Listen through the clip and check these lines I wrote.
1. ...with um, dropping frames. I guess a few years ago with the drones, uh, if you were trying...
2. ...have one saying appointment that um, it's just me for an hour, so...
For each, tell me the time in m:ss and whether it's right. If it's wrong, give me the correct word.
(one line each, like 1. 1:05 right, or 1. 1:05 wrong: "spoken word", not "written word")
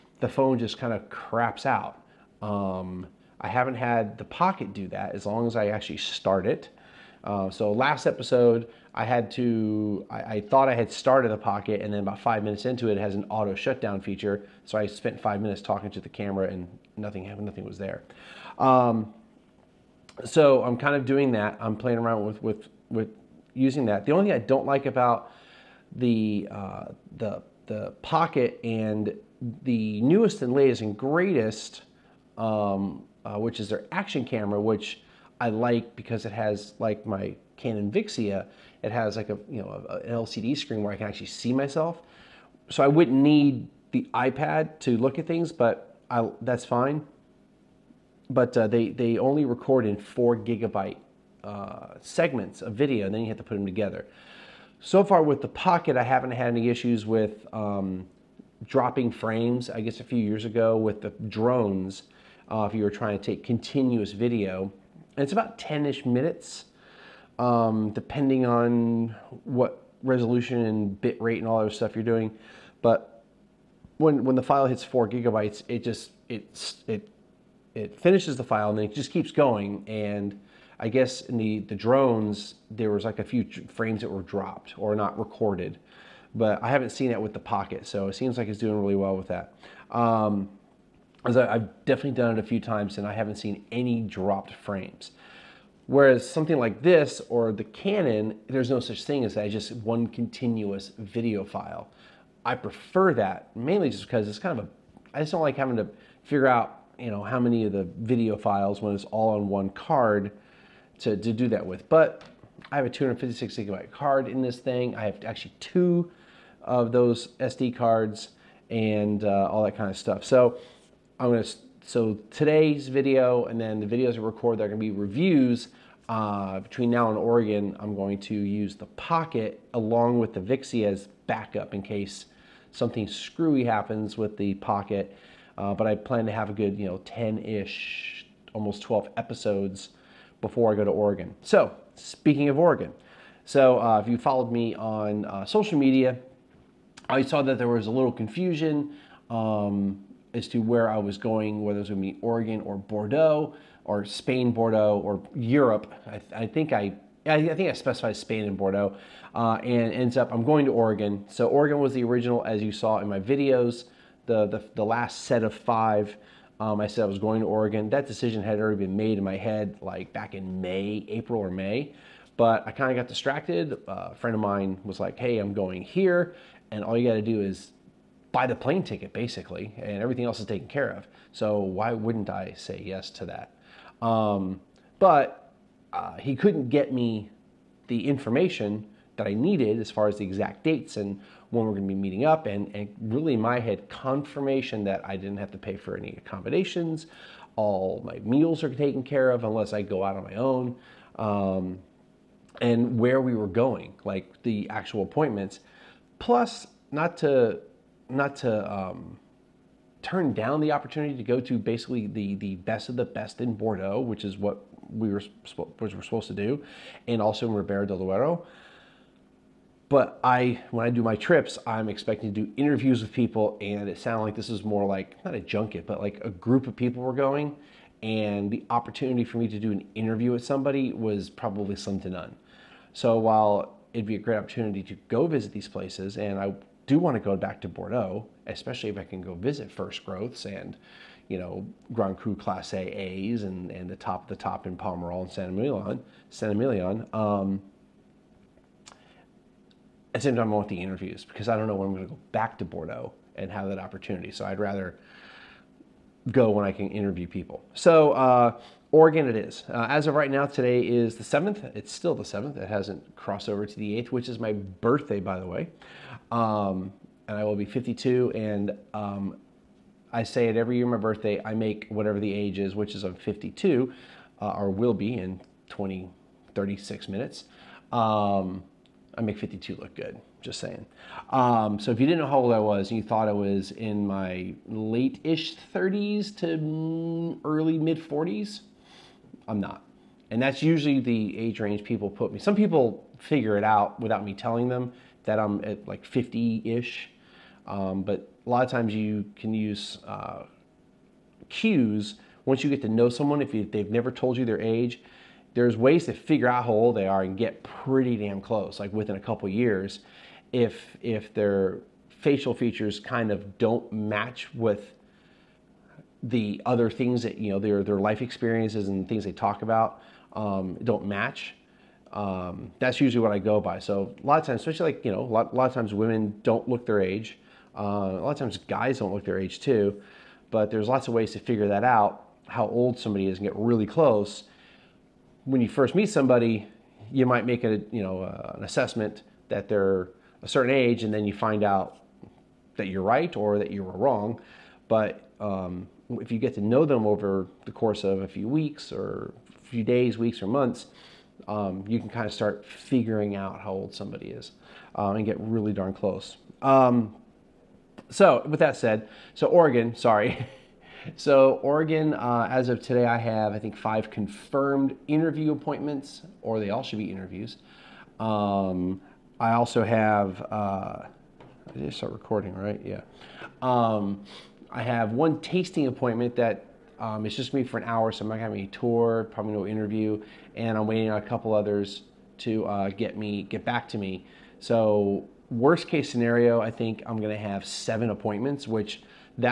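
1. 0:57 right
2. 6:14 wrong: "tasting", not "saying".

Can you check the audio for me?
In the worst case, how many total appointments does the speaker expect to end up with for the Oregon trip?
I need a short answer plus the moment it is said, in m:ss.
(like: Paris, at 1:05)
7, at 6:27.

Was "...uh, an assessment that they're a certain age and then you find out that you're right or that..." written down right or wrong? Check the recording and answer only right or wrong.
right.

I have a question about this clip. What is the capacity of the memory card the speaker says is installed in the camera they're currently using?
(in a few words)
256 gigabytes.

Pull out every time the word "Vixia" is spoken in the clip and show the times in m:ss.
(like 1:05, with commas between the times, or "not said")
0:37, 2:10.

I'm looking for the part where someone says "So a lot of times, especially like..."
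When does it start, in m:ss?
5:23.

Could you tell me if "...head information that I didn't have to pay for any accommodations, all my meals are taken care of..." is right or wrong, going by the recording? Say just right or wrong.
wrong.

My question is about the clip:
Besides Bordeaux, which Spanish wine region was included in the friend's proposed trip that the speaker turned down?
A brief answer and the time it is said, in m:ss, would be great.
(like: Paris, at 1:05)
Ribera del Duero, at 3:37.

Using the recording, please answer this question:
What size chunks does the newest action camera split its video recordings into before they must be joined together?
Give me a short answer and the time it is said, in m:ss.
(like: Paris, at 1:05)
4 gigabytes, at 0:49.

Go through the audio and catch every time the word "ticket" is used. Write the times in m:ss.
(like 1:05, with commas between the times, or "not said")
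2:58.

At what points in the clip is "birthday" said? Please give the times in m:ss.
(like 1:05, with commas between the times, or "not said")
4:24, 4:30.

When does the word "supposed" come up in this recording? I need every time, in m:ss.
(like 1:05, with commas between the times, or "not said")
3:36.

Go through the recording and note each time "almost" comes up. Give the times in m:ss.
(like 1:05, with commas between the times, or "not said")
2:18.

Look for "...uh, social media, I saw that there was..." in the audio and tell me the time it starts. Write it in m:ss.
2:25.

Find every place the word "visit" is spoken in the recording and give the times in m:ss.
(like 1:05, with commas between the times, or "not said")
3:55, 3:59.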